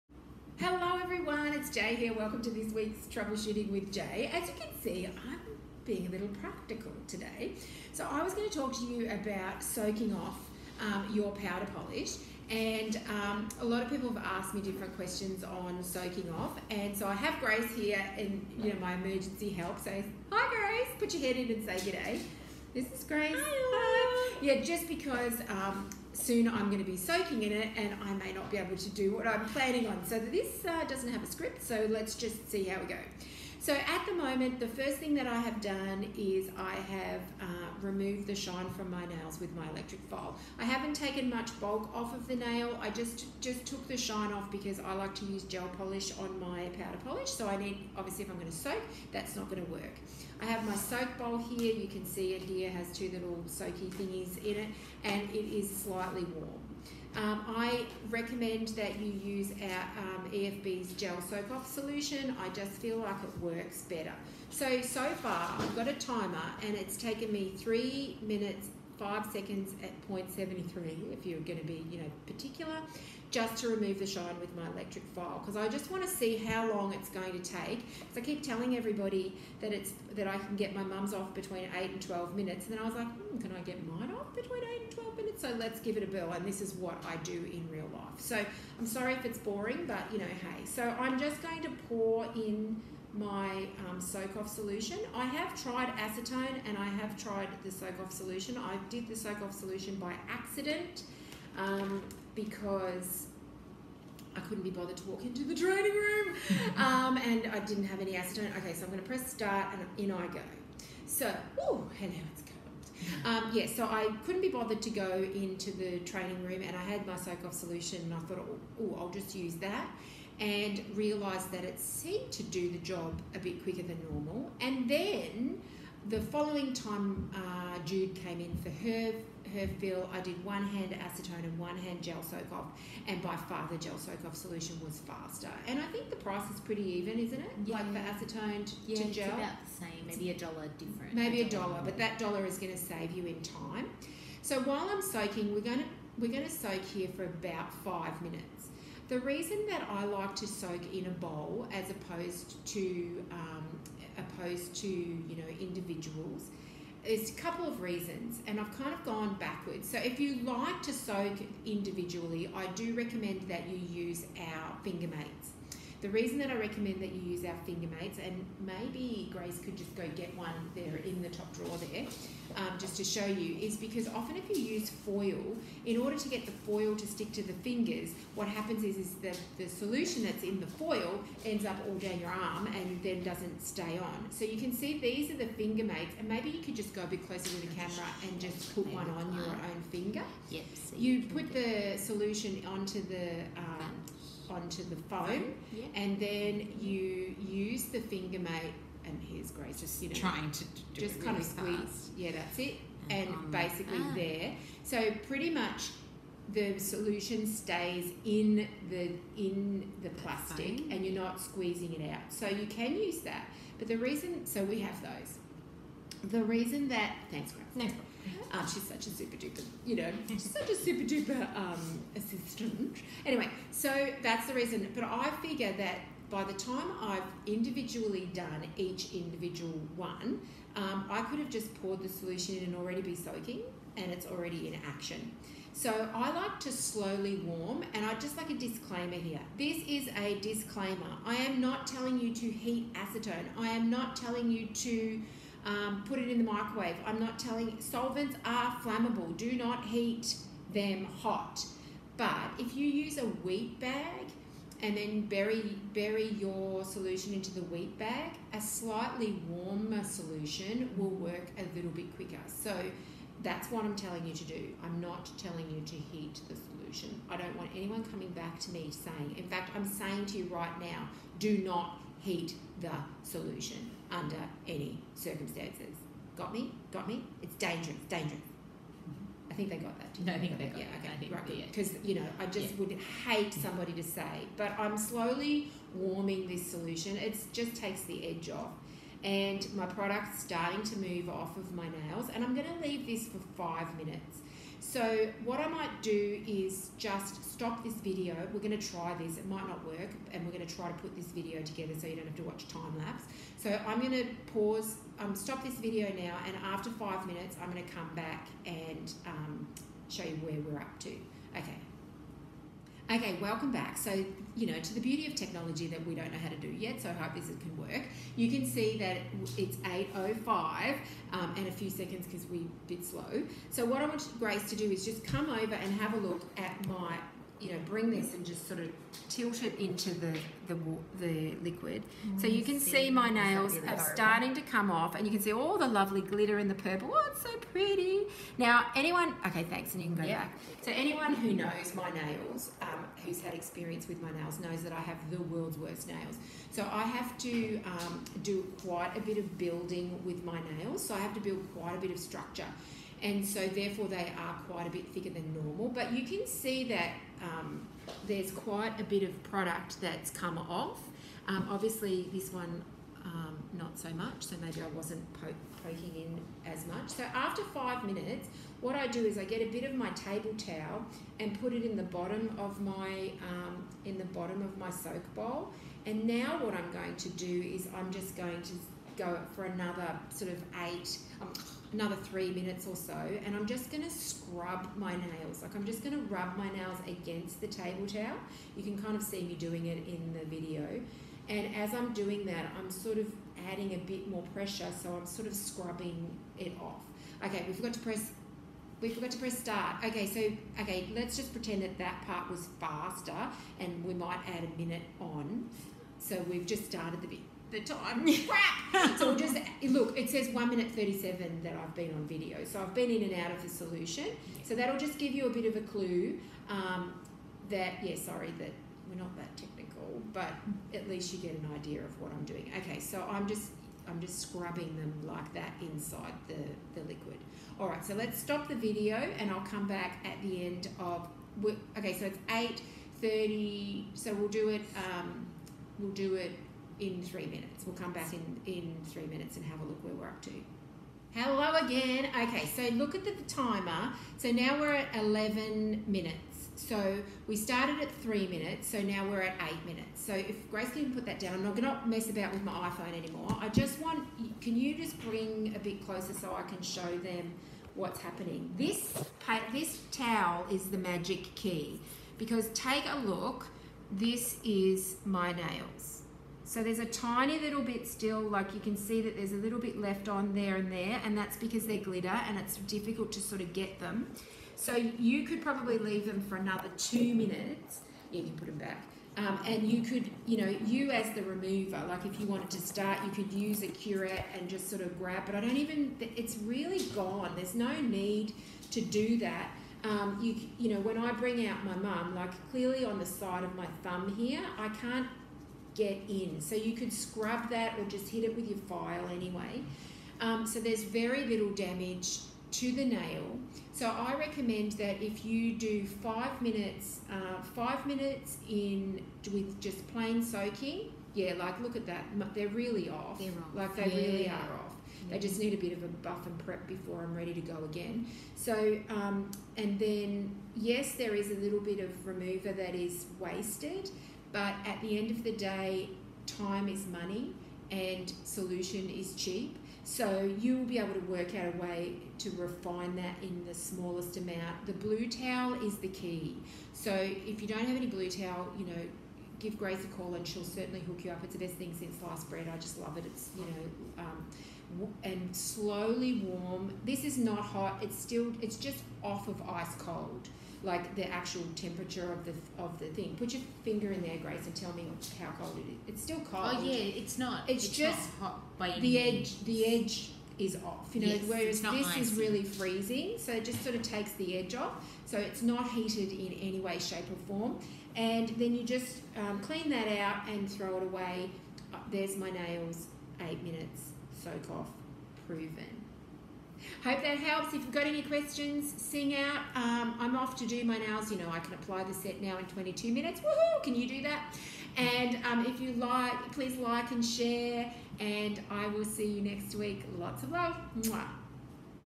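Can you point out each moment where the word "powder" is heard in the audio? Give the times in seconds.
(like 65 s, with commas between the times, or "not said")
11 s, 46 s.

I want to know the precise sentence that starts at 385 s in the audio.
Like I'm just going to rub my nails against the table towel.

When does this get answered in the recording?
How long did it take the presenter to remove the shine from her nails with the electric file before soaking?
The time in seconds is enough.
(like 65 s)
67 s.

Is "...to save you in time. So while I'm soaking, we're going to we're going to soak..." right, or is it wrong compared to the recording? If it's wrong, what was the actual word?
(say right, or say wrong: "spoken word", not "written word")
right.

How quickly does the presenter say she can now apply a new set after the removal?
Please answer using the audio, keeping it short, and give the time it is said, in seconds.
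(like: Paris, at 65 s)
22 minutes, at 582 s.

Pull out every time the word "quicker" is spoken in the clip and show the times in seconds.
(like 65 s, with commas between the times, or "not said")
123 s, 262 s.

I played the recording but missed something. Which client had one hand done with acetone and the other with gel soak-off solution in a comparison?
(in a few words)
Jude.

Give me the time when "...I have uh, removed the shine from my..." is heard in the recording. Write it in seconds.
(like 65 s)
36 s.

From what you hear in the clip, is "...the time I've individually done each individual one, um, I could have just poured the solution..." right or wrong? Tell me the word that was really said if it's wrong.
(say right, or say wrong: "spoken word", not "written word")
right.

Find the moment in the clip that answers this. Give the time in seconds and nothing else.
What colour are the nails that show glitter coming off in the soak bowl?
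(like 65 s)
336 s.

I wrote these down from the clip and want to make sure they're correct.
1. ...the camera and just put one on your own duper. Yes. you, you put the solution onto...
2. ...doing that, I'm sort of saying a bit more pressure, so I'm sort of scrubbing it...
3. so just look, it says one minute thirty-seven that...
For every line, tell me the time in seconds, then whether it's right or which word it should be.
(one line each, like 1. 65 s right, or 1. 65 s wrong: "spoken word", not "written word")
1. 187 s wrong: "finger", not "duper"
2. 392 s wrong: "adding", not "saying"
3. 409 s right.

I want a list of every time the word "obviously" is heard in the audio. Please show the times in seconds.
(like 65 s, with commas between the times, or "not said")
47 s, 361 s.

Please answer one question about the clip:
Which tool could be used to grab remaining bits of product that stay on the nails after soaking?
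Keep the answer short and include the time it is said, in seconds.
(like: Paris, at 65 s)
A curette, at 483 s.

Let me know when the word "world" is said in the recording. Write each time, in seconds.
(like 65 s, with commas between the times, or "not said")
345 s.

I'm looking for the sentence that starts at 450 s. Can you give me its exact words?
So if Grace can put that down, I'm not gonna mess about with my iPhone anymore.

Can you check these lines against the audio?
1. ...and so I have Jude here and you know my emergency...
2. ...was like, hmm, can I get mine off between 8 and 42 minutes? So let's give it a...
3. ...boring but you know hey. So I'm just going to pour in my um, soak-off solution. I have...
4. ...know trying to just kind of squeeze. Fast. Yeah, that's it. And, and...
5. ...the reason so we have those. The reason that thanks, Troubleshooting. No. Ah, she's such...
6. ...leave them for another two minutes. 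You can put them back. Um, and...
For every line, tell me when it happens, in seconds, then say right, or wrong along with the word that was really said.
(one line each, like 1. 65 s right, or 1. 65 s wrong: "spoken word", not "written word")
1. 16 s wrong: "Grace", not "Jude"
2. 82 s wrong: "12", not "42"
3. 89 s right
4. 200 s right
5. 213 s wrong: "Grace", not "Troubleshooting"
6. 475 s right.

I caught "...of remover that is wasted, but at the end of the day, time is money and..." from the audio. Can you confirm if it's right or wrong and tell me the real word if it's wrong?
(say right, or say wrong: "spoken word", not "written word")
right.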